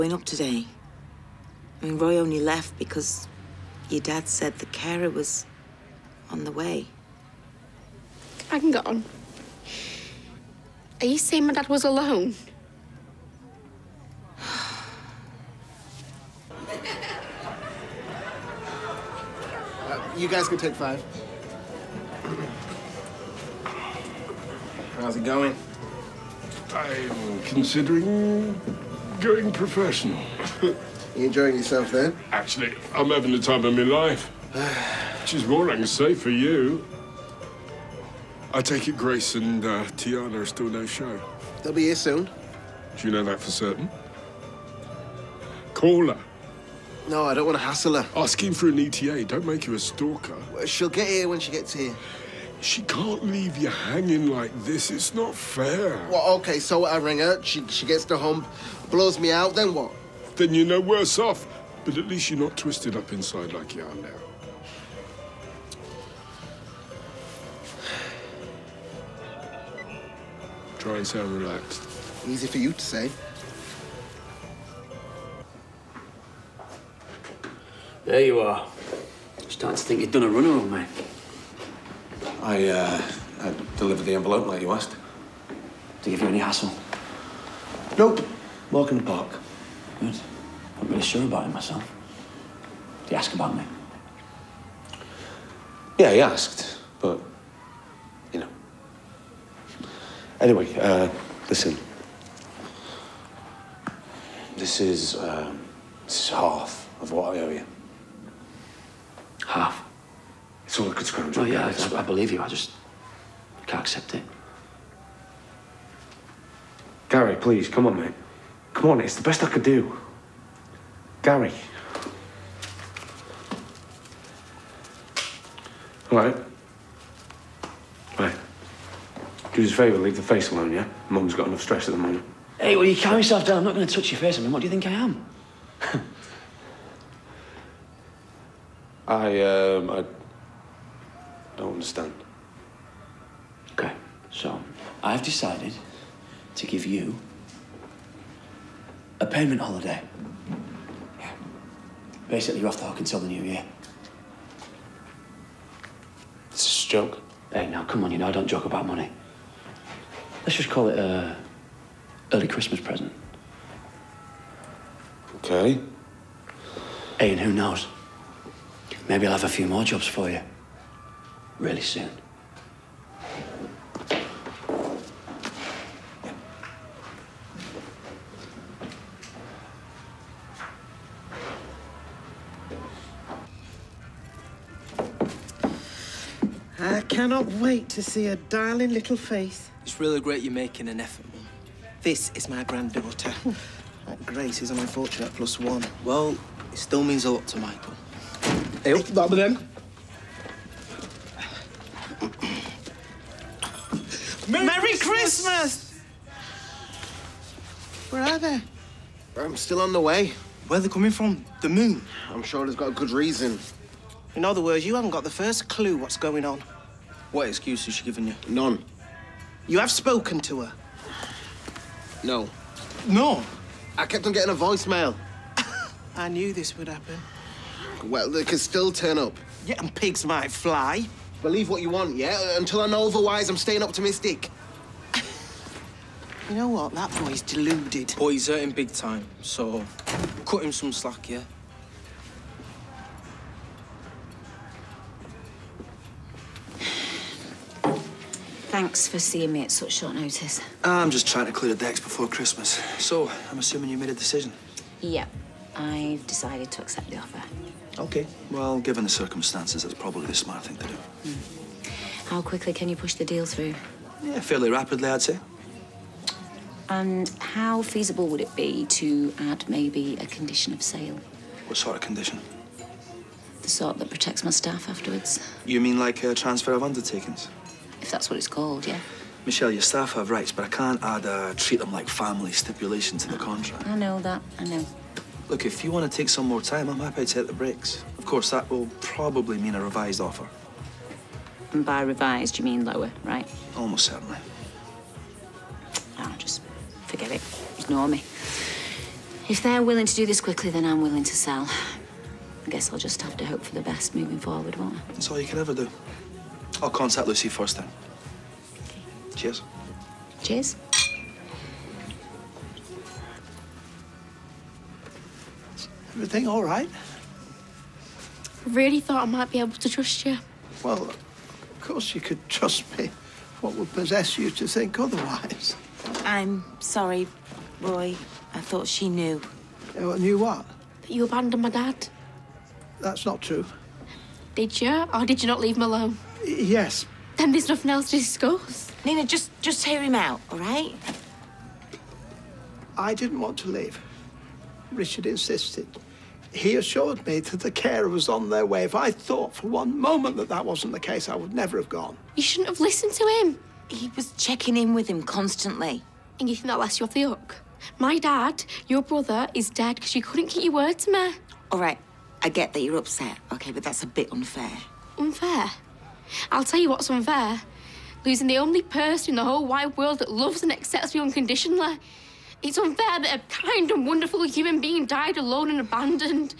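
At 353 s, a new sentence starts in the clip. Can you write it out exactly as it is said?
He was checking in with him constantly.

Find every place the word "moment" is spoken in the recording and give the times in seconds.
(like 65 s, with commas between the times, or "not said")
131 s, 349 s.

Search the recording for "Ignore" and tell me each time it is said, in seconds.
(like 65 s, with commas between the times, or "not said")
297 s.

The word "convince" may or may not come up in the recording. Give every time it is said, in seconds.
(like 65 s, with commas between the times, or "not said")
not said.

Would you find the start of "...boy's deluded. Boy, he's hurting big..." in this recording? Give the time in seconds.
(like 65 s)
237 s.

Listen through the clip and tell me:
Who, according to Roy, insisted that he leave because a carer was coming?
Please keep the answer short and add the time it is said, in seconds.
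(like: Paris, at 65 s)
Richard, at 344 s.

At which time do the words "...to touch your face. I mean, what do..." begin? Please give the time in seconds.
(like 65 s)
133 s.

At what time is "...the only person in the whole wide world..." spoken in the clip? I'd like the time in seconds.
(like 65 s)
368 s.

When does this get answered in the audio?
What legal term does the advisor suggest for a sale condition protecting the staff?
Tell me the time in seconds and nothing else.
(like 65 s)
276 s.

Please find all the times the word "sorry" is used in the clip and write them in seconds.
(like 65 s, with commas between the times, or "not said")
326 s.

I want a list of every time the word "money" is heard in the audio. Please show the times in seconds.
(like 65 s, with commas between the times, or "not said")
158 s.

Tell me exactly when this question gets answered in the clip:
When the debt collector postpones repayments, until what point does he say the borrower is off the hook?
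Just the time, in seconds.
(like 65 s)
153 s.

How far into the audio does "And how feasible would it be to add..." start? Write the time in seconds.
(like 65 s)
266 s.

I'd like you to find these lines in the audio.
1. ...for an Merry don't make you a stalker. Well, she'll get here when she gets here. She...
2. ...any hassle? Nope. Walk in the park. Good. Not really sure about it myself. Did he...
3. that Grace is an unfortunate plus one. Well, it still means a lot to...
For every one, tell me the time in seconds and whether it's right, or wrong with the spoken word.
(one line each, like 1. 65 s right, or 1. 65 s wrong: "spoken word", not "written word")
1. 48 s wrong: "ETA", not "Merry"
2. 86 s right
3. 194 s right.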